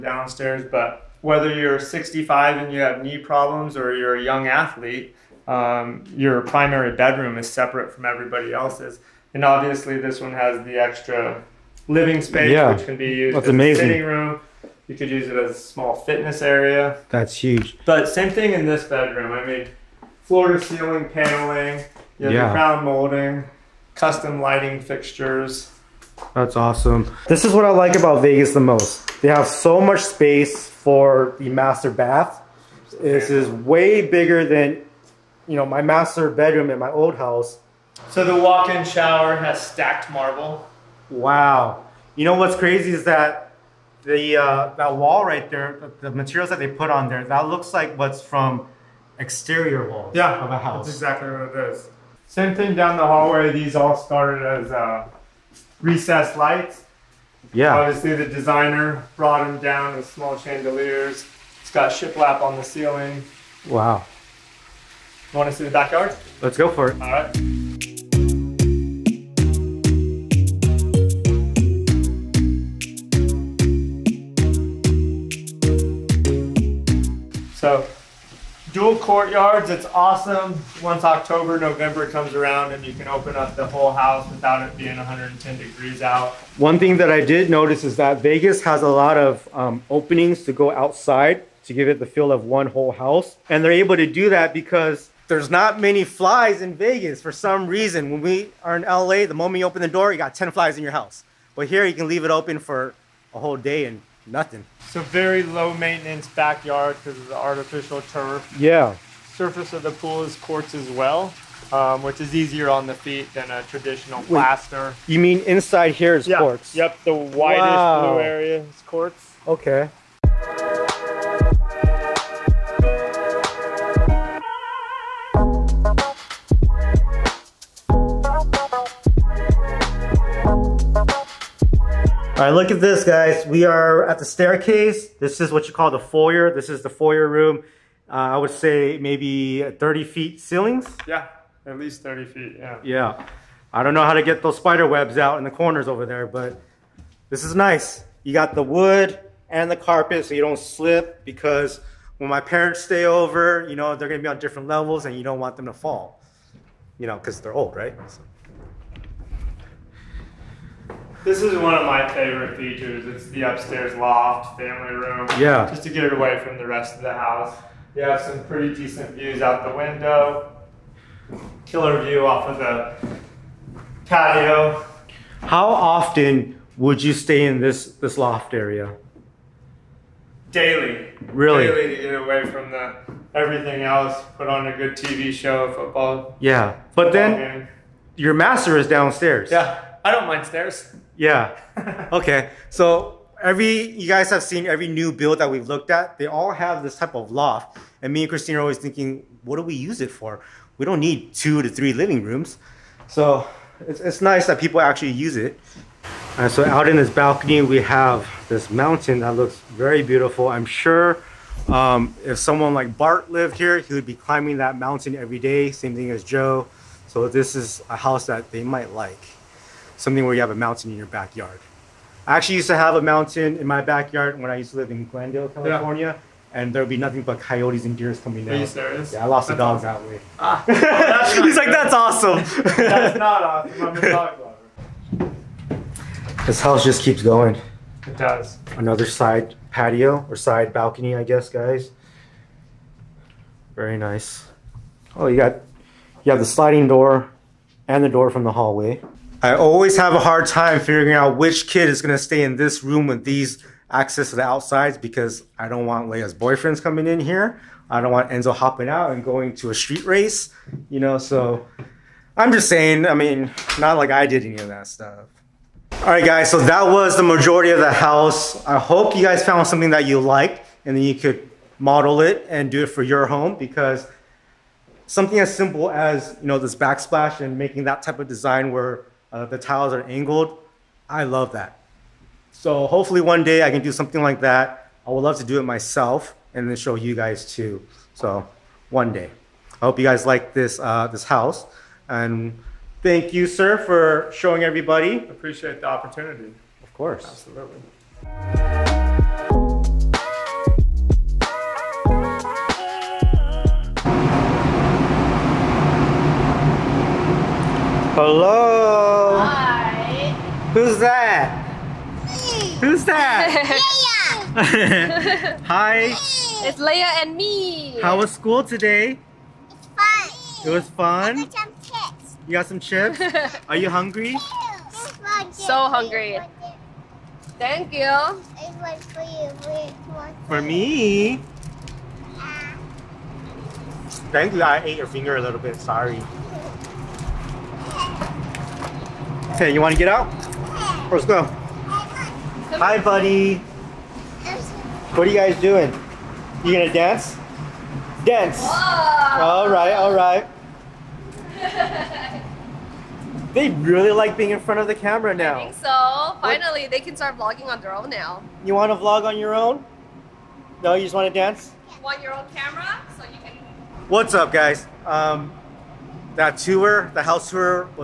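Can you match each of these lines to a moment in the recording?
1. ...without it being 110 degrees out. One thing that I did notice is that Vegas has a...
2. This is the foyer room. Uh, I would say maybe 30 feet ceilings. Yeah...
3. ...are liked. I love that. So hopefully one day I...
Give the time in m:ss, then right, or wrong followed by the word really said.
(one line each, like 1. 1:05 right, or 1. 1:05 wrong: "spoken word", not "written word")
1. 1:24 right
2. 2:16 right
3. 4:39 wrong: "angled", not "liked".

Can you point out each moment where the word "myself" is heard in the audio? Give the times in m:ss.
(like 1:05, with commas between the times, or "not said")
4:45.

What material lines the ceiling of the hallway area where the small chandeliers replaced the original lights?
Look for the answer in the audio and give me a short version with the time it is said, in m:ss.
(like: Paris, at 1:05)
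Shiplap, at 1:01.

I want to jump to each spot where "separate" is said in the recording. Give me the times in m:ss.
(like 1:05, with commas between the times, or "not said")
0:07.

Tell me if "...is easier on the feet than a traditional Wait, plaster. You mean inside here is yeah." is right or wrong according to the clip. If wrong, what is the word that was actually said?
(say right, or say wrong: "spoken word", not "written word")
right.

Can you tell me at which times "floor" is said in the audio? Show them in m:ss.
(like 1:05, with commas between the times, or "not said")
0:20.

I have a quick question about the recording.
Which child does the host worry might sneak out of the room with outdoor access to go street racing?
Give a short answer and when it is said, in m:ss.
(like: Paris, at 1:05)
Enzo, at 4:18.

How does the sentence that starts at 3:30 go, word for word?
I'm sure um, if someone like Bart lived here, he would be climbing that mountain every day.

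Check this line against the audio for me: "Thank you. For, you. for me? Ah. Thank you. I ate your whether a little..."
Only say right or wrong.
wrong.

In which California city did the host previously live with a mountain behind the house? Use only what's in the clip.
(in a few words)
Glendale.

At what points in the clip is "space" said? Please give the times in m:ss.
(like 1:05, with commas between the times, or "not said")
0:12, 0:30.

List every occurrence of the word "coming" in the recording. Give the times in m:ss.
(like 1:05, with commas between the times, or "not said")
3:48, 4:16.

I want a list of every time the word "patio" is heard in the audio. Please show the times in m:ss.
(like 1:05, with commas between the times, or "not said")
2:54, 3:59.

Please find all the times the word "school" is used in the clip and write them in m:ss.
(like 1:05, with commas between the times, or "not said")
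5:18.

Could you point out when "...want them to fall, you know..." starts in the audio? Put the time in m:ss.
2:35.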